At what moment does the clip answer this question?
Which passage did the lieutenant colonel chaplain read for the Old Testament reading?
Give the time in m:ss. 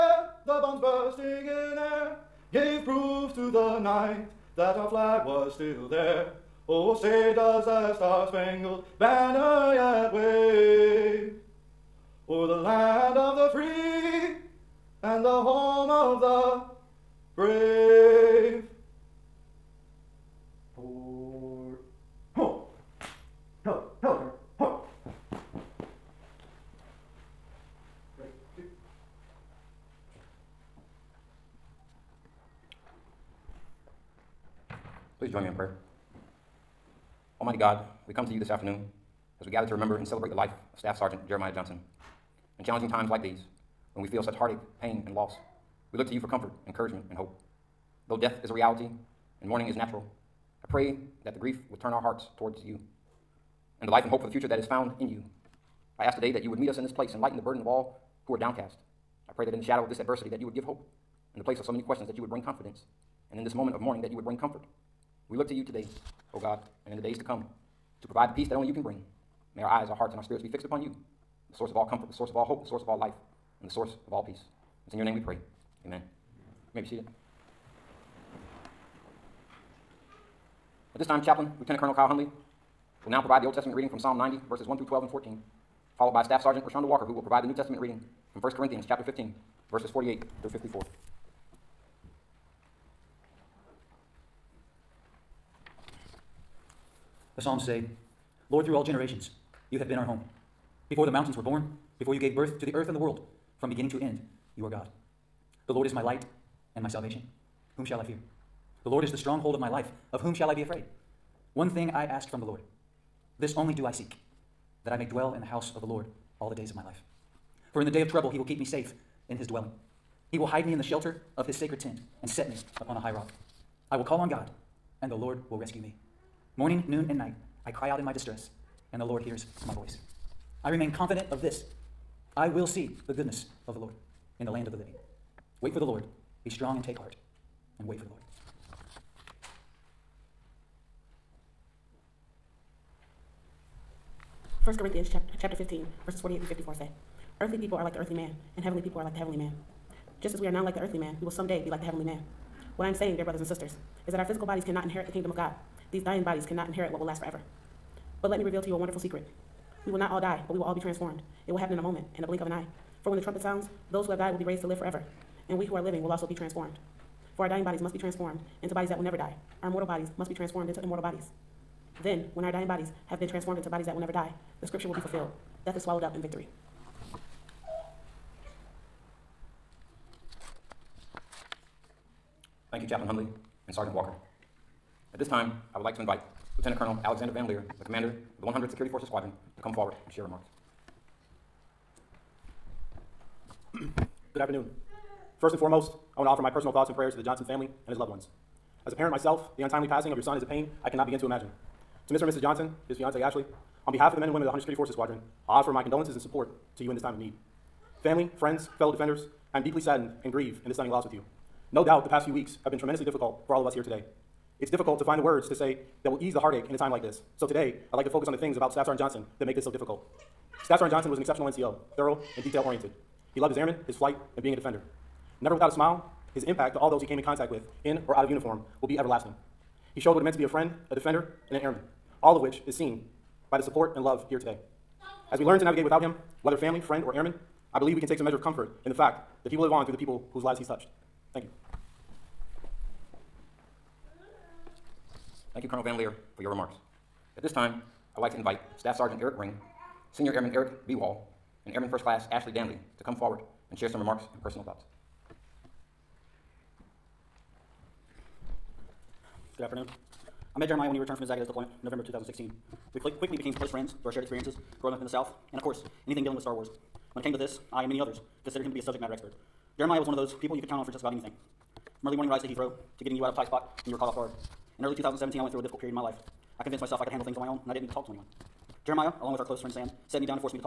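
1:23.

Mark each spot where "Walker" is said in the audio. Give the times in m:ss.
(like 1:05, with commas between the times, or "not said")
1:26, 3:03.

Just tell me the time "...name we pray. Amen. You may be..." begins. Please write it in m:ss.
1:15.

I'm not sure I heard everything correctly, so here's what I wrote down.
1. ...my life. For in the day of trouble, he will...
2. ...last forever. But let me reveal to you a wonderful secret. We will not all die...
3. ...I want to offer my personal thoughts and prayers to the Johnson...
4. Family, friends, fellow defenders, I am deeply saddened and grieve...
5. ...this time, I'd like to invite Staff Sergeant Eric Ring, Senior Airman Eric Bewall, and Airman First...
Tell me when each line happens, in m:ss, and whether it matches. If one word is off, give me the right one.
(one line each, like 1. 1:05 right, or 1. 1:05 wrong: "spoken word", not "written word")
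1. 1:56 right
2. 2:37 right
3. 3:16 right
4. 3:28 right
5. 4:07 right.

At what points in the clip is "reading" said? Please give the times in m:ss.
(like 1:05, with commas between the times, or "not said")
1:23, 1:27.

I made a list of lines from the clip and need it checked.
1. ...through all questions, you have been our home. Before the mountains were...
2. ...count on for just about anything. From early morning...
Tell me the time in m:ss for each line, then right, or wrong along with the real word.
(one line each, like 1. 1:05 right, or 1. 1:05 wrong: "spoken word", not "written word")
1. 1:38 wrong: "generations", not "questions"
2. 4:30 right.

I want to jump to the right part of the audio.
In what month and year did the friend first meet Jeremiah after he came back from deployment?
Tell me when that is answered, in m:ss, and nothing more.
4:21.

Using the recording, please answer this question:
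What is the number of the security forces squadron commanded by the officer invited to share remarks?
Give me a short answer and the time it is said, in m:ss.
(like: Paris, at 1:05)
100th, at 3:08.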